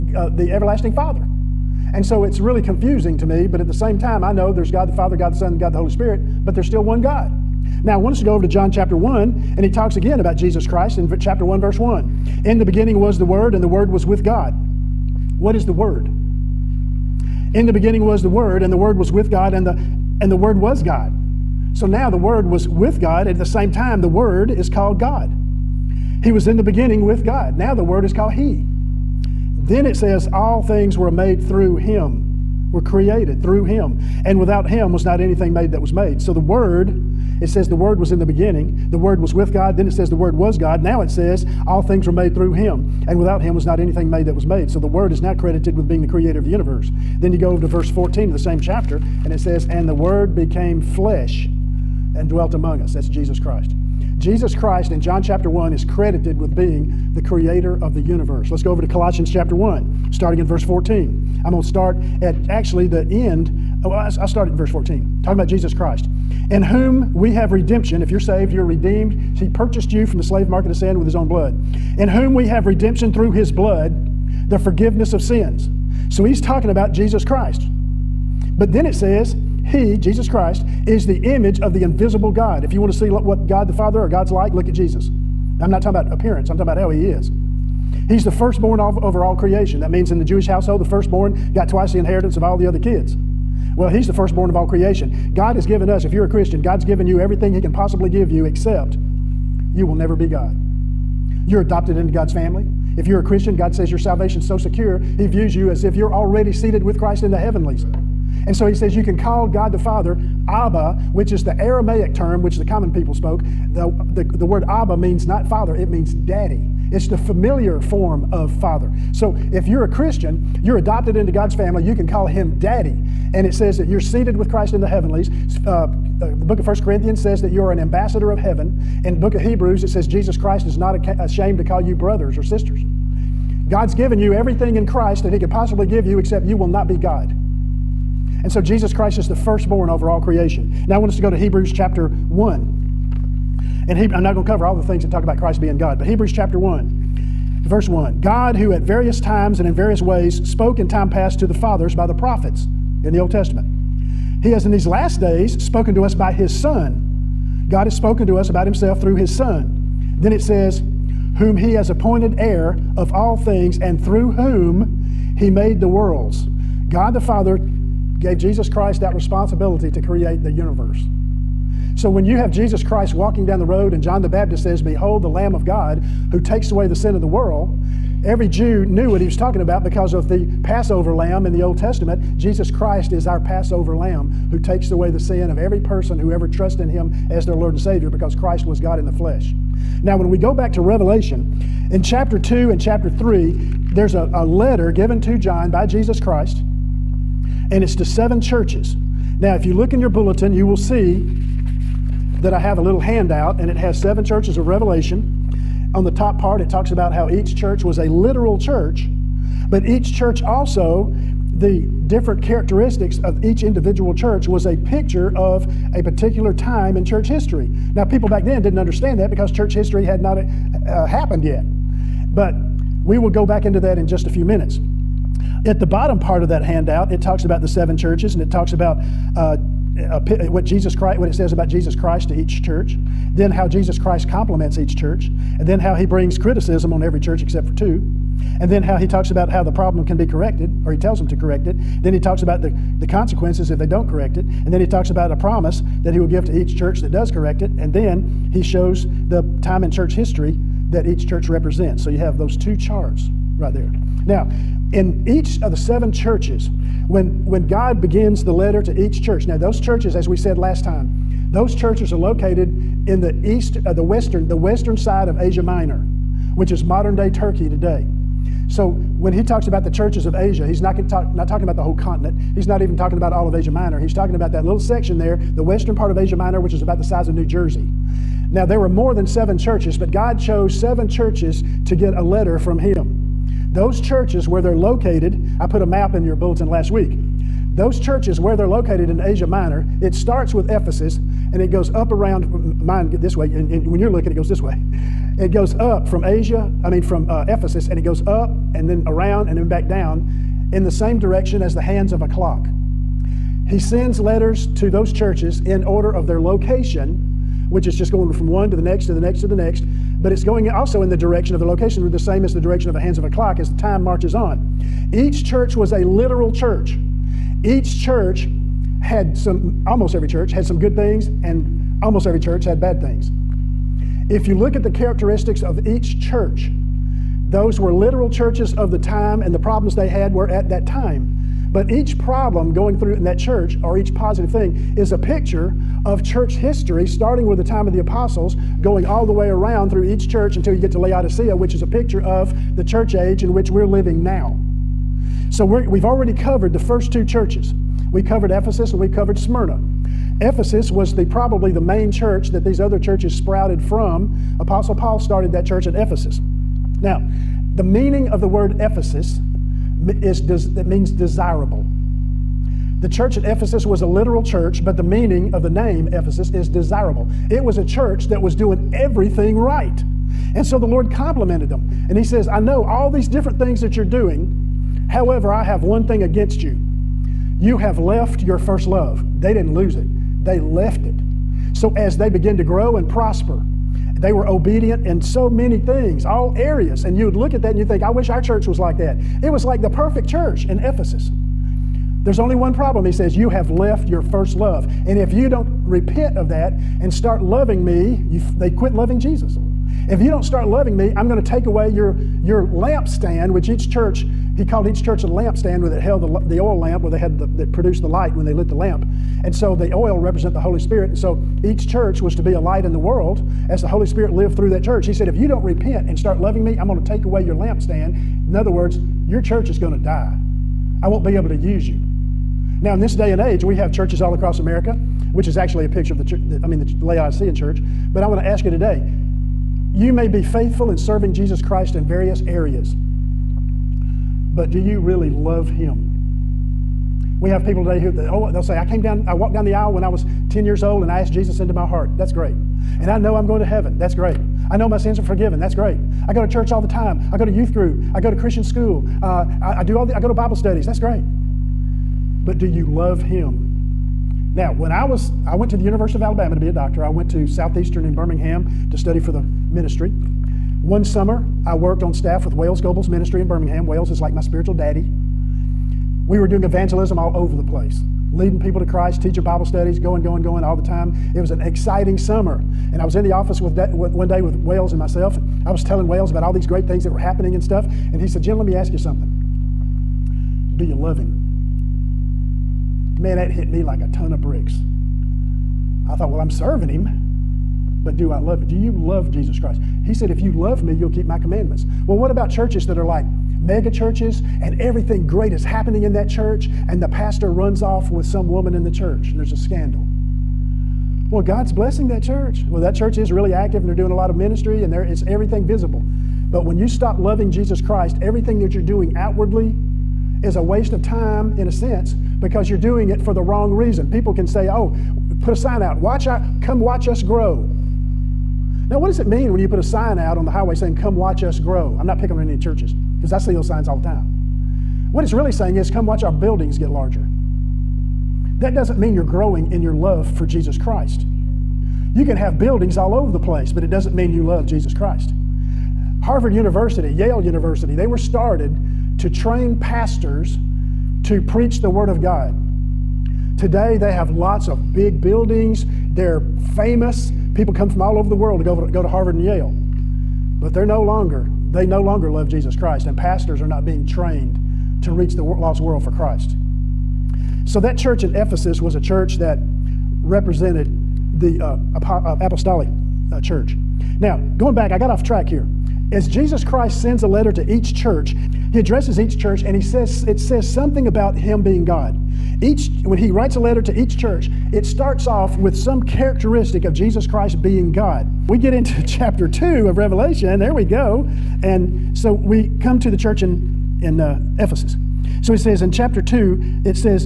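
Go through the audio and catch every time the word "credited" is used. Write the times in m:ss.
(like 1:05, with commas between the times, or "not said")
0:45, 0:55.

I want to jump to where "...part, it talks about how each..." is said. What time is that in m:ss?
3:26.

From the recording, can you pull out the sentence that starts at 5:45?
So we have already covered the first two churches.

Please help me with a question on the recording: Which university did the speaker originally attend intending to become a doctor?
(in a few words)
University of Alabama.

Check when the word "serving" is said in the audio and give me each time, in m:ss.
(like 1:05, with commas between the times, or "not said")
7:10, 8:06.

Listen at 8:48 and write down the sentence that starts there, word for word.
That doesn't mean you're growing in your love for Jesus Christ.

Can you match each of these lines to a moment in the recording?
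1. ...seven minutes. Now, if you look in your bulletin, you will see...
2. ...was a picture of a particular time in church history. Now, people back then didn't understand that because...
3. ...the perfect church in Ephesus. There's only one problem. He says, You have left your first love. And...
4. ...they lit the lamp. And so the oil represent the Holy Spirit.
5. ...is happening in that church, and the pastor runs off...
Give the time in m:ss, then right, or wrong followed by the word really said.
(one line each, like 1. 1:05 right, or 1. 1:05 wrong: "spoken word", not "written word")
1. 3:18 wrong: "churches", not "minutes"
2. 3:34 right
3. 6:29 right
4. 6:48 right
5. 8:15 right.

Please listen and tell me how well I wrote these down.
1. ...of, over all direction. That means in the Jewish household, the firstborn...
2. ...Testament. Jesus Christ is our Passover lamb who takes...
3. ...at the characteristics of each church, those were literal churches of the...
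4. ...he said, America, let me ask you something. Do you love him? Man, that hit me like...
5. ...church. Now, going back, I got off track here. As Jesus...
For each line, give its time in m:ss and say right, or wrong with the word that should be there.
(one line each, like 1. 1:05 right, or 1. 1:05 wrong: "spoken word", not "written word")
1. 1:28 wrong: "creation", not "direction"
2. 3:01 right
3. 5:24 right
4. 7:58 wrong: "Jim", not "America"
5. 9:23 right.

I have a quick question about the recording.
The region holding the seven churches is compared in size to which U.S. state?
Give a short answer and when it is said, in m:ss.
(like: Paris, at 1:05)
New Jersey, at 4:37.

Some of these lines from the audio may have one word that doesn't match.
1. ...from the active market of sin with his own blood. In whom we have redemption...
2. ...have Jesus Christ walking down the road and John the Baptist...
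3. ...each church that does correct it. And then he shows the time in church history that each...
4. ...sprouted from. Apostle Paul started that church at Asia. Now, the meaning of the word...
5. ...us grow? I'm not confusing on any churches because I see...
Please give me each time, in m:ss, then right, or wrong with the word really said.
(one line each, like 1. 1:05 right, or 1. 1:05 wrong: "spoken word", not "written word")
1. 1:10 wrong: "slave", not "active"
2. 2:52 right
3. 4:06 right
4. 5:53 wrong: "Ephesus", not "Asia"
5. 8:41 wrong: "picking", not "confusing".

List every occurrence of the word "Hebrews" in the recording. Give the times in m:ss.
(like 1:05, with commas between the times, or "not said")
2:09, 2:21, 2:26.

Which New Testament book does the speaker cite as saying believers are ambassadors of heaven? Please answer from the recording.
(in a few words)
1 Corinthians.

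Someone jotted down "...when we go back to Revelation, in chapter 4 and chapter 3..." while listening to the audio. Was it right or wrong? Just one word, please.
wrong.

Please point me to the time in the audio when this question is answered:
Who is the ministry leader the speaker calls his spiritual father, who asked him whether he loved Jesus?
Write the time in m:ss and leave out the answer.
7:42.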